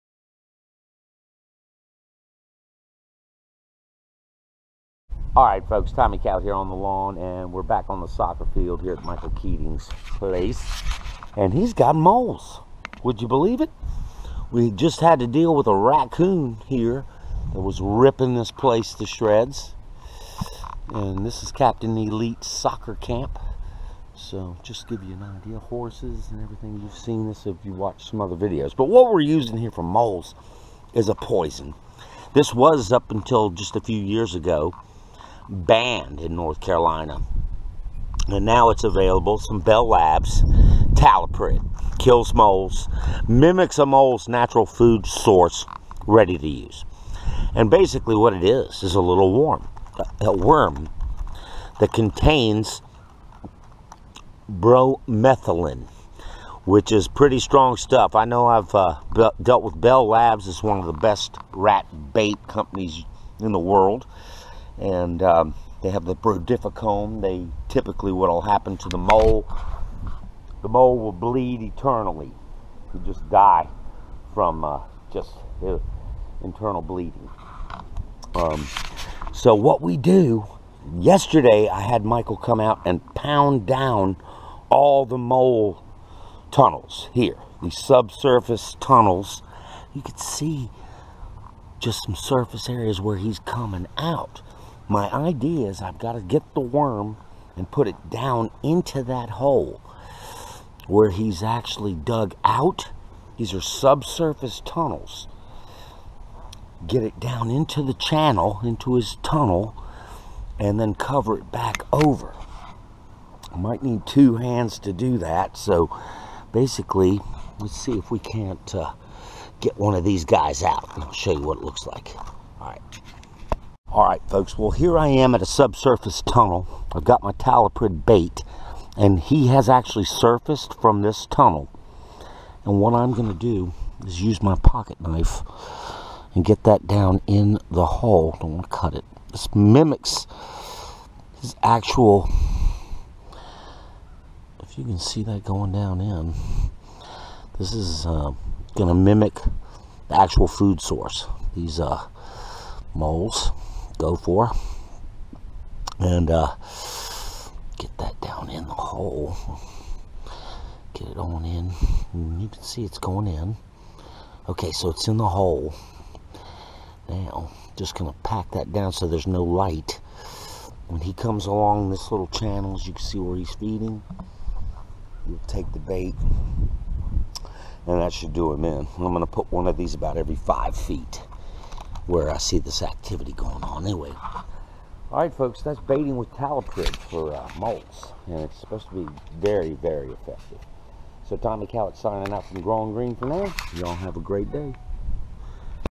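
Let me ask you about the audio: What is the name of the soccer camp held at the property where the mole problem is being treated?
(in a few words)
Captain Elite Soccer Camp.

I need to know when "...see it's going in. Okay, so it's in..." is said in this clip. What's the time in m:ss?
2:42.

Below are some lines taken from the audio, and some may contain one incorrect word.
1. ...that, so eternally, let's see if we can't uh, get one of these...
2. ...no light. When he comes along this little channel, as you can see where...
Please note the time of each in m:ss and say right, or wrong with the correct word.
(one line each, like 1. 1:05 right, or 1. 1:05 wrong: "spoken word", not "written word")
1. 1:55 wrong: "basically", not "eternally"
2. 2:49 right.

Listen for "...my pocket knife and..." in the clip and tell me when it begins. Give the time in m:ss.
2:14.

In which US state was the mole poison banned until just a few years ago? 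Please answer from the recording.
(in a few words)
North Carolina.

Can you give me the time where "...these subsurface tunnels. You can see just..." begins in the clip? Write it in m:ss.
1:27.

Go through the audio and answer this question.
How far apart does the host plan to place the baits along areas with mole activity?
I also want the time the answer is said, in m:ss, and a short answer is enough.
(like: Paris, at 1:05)
5 feet, at 3:00.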